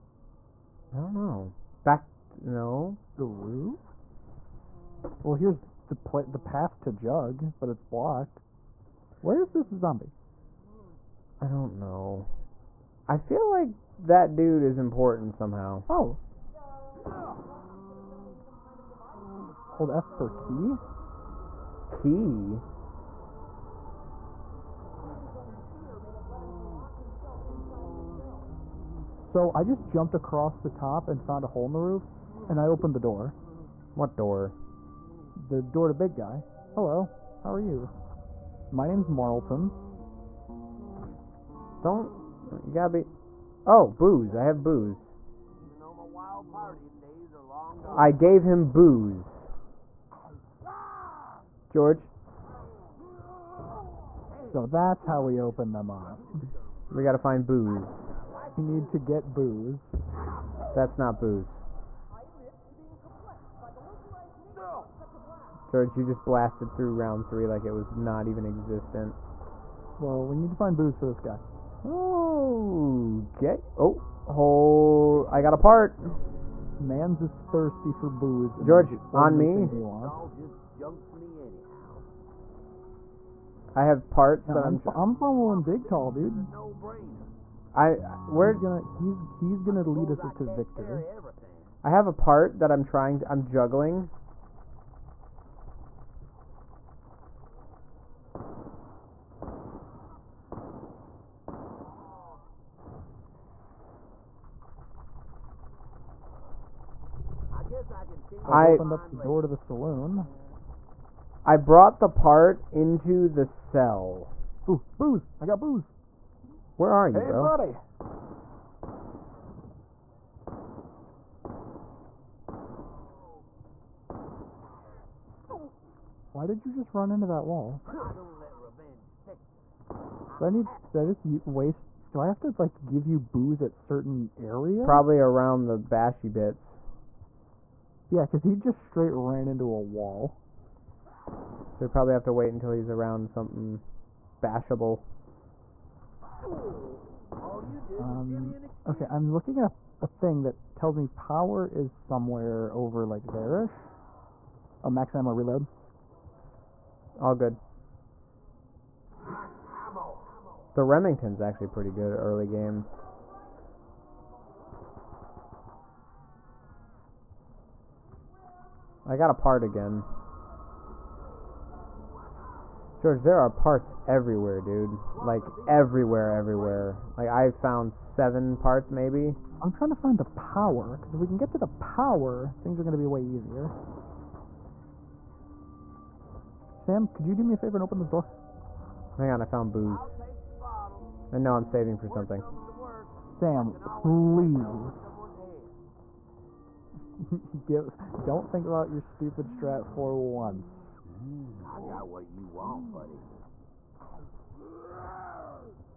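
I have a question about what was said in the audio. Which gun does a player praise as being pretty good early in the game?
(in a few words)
Remington.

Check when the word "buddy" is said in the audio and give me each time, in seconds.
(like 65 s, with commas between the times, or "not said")
117 s, 202 s.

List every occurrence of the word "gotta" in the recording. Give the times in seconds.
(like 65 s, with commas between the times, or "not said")
42 s, 57 s.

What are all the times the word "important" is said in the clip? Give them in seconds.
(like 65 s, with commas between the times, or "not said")
14 s.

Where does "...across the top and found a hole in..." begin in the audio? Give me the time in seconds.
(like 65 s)
30 s.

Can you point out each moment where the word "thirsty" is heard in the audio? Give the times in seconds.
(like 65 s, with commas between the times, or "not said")
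77 s.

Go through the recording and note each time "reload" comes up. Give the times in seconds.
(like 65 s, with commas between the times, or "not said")
155 s.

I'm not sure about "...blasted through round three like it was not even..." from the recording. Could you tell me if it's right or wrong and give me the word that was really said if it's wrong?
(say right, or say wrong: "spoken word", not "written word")
right.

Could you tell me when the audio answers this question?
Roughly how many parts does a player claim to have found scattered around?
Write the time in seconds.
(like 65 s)
177 s.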